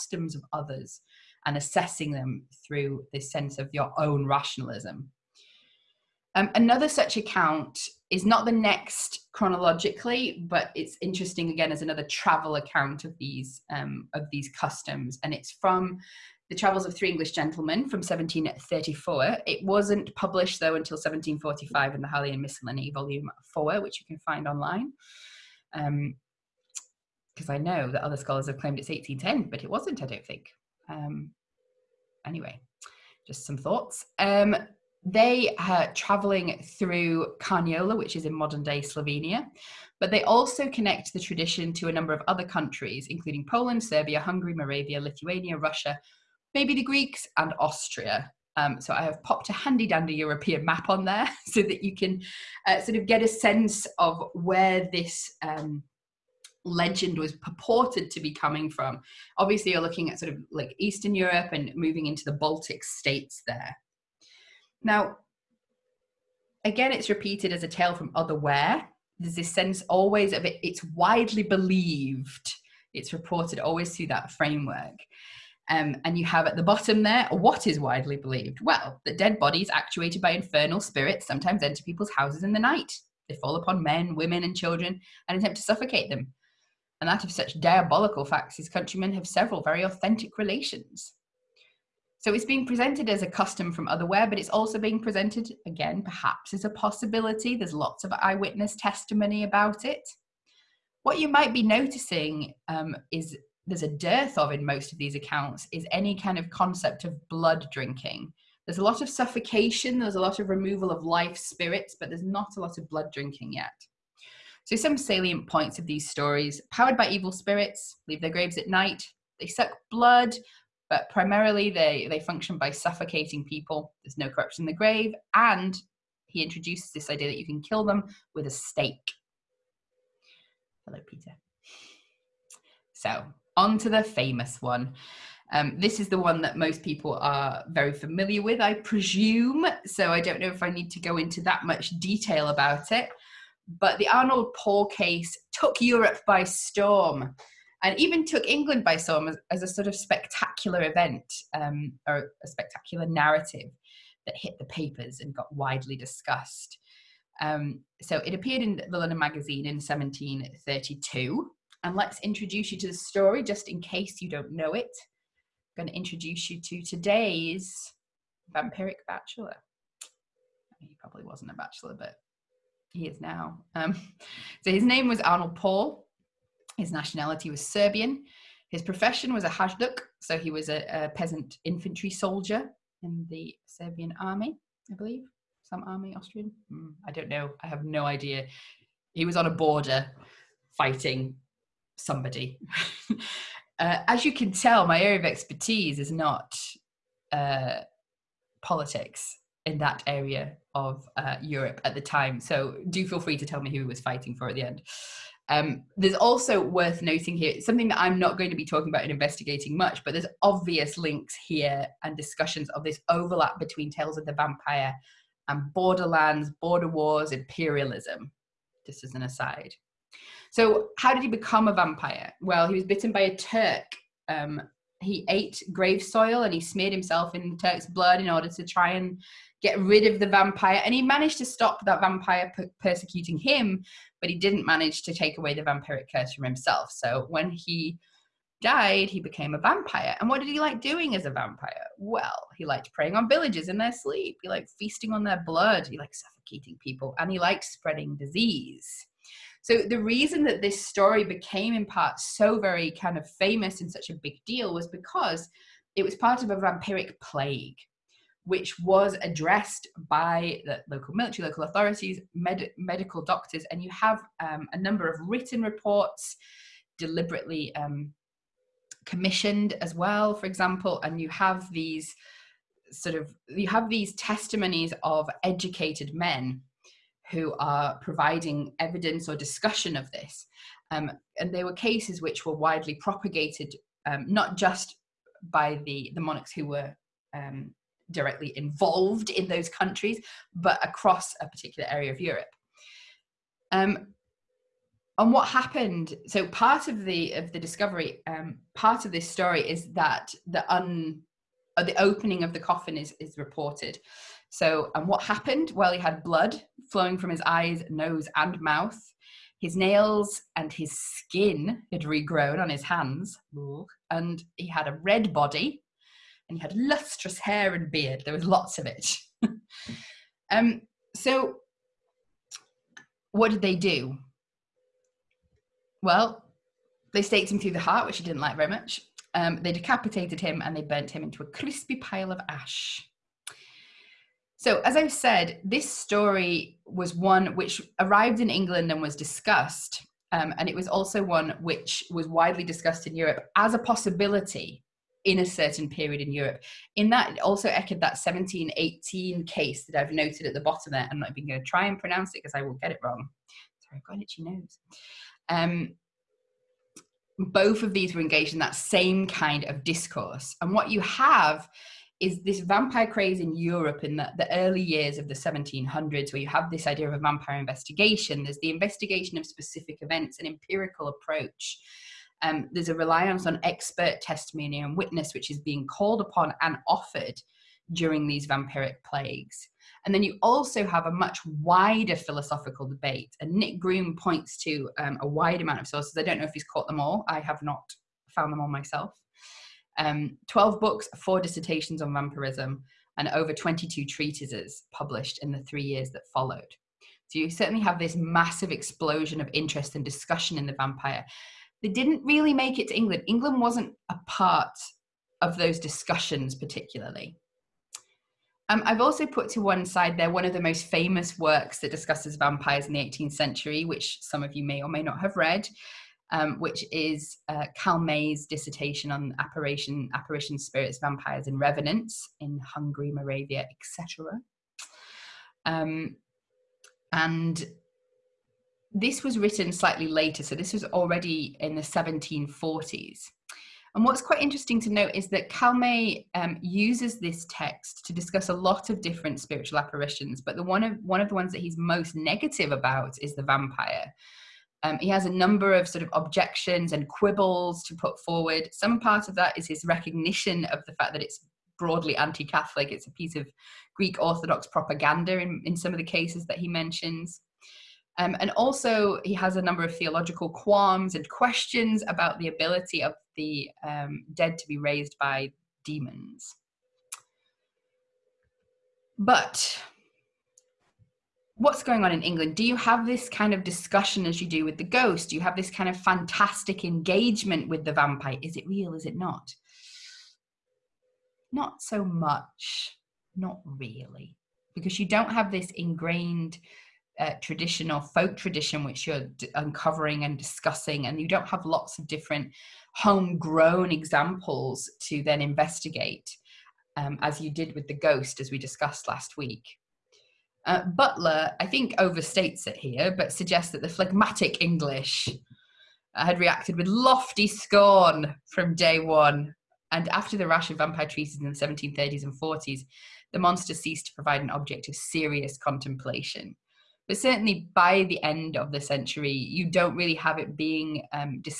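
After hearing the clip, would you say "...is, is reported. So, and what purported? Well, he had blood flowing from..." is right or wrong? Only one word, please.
wrong.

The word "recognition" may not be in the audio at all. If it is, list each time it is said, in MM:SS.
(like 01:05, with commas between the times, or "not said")
07:29.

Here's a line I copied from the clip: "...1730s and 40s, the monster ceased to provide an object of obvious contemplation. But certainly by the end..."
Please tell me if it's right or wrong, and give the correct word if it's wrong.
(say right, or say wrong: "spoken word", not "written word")
wrong: "serious", not "obvious".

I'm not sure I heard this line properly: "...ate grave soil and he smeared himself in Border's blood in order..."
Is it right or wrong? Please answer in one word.
wrong.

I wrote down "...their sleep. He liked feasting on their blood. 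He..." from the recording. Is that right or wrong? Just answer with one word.
right.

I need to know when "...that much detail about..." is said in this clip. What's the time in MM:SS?
02:21.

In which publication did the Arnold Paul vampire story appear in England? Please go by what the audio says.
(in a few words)
London Magazine.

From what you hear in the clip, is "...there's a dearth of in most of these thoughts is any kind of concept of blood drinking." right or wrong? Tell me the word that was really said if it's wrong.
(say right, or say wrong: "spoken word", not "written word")
wrong: "accounts", not "thoughts".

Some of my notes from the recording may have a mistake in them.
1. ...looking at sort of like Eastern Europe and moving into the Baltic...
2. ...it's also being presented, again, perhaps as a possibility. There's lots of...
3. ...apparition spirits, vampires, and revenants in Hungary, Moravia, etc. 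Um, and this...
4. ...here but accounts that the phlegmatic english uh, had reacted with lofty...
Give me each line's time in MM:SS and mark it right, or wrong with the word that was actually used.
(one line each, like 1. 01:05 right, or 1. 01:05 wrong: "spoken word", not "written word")
1. 00:59 right
2. 01:34 right
3. 07:00 right
4. 08:22 wrong: "suggests", not "accounts".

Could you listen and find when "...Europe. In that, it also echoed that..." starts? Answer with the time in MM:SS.
05:46.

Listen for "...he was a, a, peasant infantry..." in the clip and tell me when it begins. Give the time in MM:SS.
03:00.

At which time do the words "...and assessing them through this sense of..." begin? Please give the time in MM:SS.
00:01.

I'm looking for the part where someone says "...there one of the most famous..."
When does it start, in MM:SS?
06:50.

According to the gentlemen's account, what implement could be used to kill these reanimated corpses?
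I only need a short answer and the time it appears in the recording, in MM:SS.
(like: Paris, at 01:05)
A stake, at 02:08.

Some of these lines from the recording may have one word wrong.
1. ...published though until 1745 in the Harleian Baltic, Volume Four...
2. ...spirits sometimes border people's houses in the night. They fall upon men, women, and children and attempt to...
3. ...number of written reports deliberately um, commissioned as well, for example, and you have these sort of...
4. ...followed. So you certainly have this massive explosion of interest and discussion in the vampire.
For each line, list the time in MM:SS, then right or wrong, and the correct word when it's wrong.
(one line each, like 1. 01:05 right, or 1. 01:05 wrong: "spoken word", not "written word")
1. 00:20 wrong: "Miscellany", not "Baltic"
2. 01:20 wrong: "enter", not "border"
3. 04:24 right
4. 06:36 right.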